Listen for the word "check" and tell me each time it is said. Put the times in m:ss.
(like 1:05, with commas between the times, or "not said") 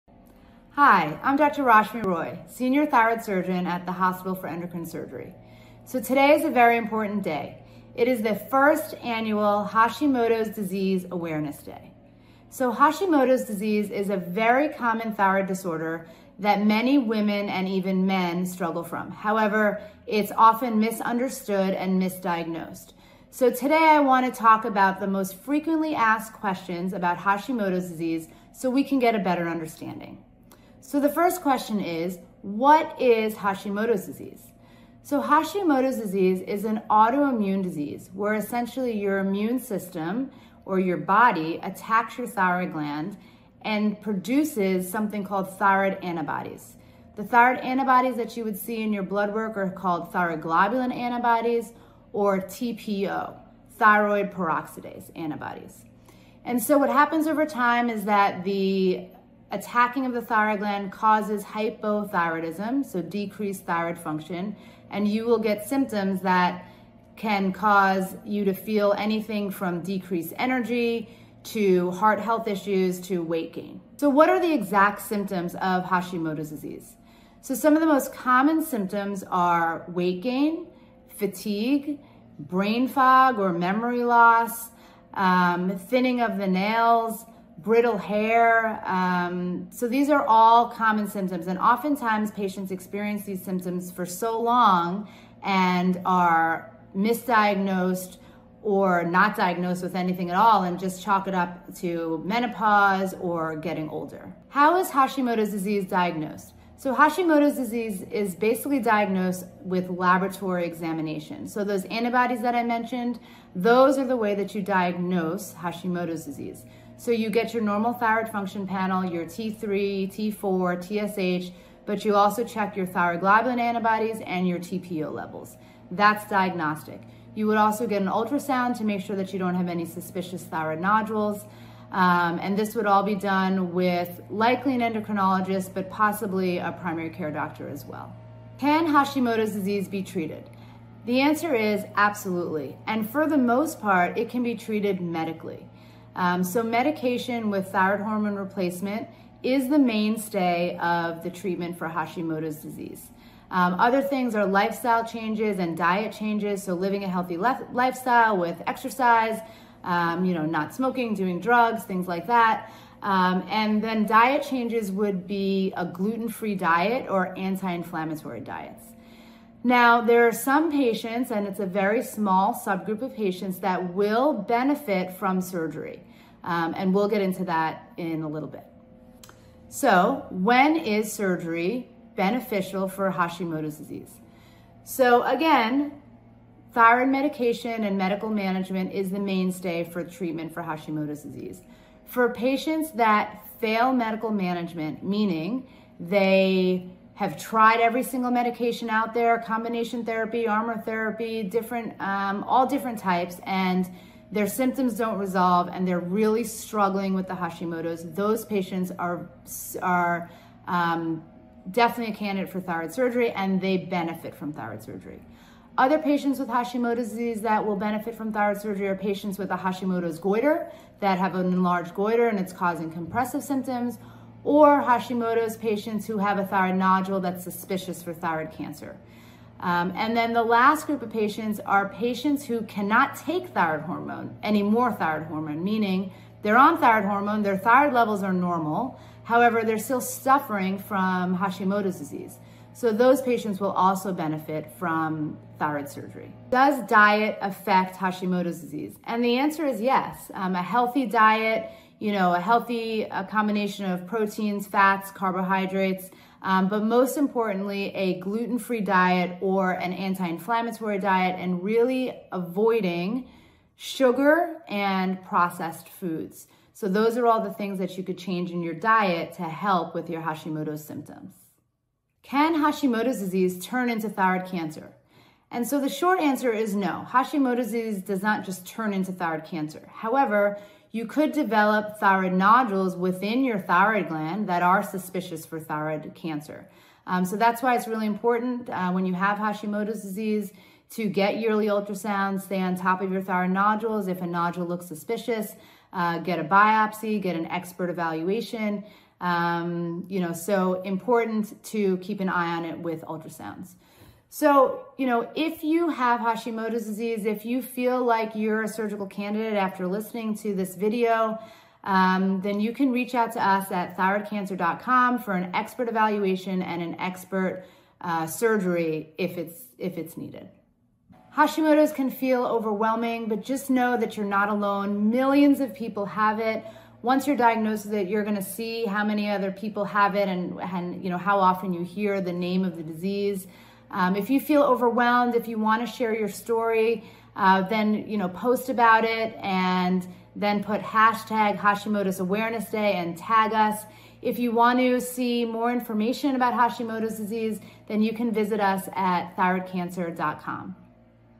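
2:02.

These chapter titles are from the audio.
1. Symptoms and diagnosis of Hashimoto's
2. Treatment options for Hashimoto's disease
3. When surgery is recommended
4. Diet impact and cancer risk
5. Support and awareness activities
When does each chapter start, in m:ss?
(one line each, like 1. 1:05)
1. 1:10
2. 2:19
3. 3:27
4. 4:30
5. 5:31.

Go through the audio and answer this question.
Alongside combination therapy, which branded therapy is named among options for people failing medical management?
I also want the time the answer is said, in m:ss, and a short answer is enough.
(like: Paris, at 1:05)
Armour therapy, at 3:20.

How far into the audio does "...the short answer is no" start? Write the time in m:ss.
4:35.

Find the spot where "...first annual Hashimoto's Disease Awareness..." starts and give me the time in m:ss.
0:08.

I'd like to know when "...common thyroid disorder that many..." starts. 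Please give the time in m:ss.
0:14.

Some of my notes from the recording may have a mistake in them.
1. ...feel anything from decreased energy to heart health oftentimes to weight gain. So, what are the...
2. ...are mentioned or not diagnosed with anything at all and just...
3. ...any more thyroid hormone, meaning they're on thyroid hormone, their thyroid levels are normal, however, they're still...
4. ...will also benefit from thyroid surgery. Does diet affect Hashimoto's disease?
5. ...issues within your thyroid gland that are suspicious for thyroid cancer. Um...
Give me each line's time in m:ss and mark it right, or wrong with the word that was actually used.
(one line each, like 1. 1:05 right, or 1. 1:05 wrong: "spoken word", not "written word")
1. 1:08 wrong: "issues", not "oftentimes"
2. 1:36 wrong: "misdiagnosed", not "mentioned"
3. 3:54 right
4. 4:03 right
5. 4:42 wrong: "nodules", not "issues".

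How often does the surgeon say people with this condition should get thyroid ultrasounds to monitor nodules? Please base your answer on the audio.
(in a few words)
yearly.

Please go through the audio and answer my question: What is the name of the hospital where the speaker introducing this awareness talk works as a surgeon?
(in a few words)
Hospital for Endocrine Surgery.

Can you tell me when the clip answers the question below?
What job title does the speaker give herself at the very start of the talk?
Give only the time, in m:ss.
0:02.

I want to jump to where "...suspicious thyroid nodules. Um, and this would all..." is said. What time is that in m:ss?
2:09.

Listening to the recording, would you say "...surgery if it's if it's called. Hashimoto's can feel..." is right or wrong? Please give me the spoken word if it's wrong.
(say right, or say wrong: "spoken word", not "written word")
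wrong: "needed", not "called".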